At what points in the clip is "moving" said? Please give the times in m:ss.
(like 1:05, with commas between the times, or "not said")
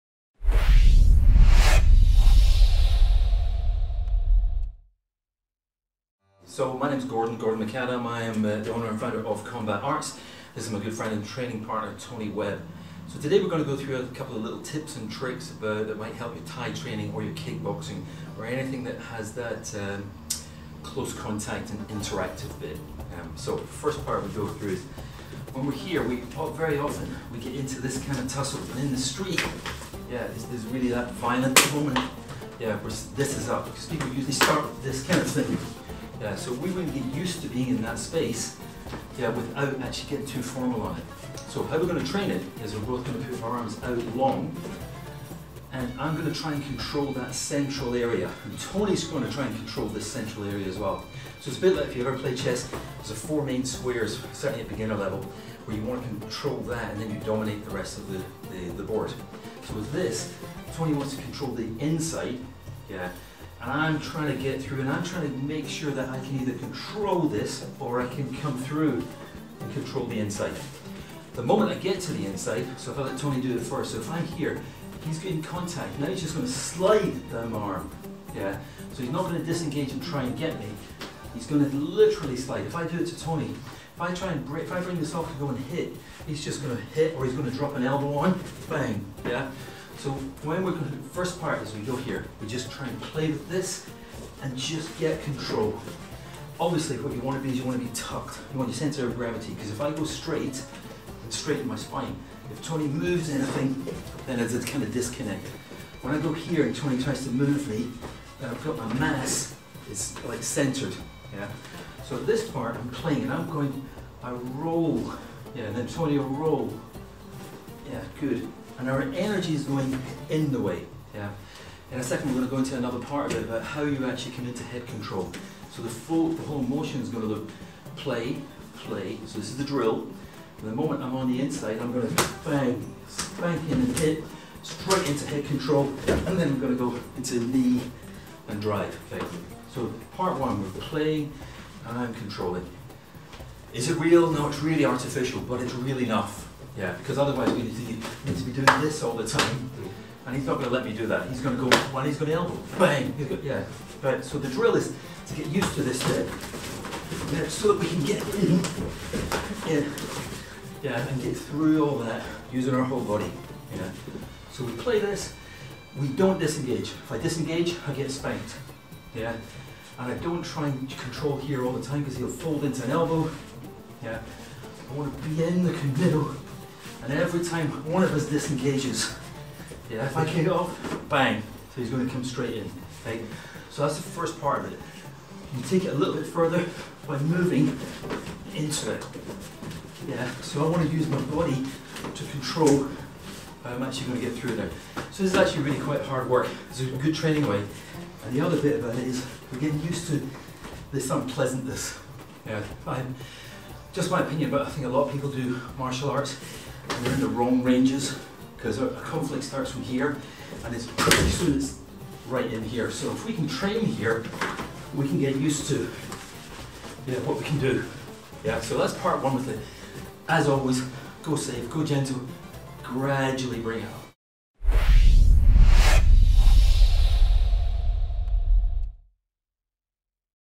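3:07.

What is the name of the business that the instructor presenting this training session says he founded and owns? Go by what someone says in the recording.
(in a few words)
Combat Arts.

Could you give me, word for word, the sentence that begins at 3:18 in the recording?
And the other bit about it is we're getting used to this unpleasantness.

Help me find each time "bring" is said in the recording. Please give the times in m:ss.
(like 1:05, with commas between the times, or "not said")
1:24, 3:43.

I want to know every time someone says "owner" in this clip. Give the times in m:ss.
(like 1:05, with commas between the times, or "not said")
0:08.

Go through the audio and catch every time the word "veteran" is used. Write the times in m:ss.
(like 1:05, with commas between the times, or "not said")
not said.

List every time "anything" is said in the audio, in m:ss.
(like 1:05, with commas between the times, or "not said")
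0:18, 1:43.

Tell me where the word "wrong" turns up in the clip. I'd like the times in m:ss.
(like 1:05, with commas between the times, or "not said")
3:27.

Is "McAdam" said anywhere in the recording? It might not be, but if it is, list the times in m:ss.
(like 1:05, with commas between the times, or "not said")
0:07.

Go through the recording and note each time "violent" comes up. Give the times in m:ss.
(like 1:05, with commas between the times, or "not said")
0:31.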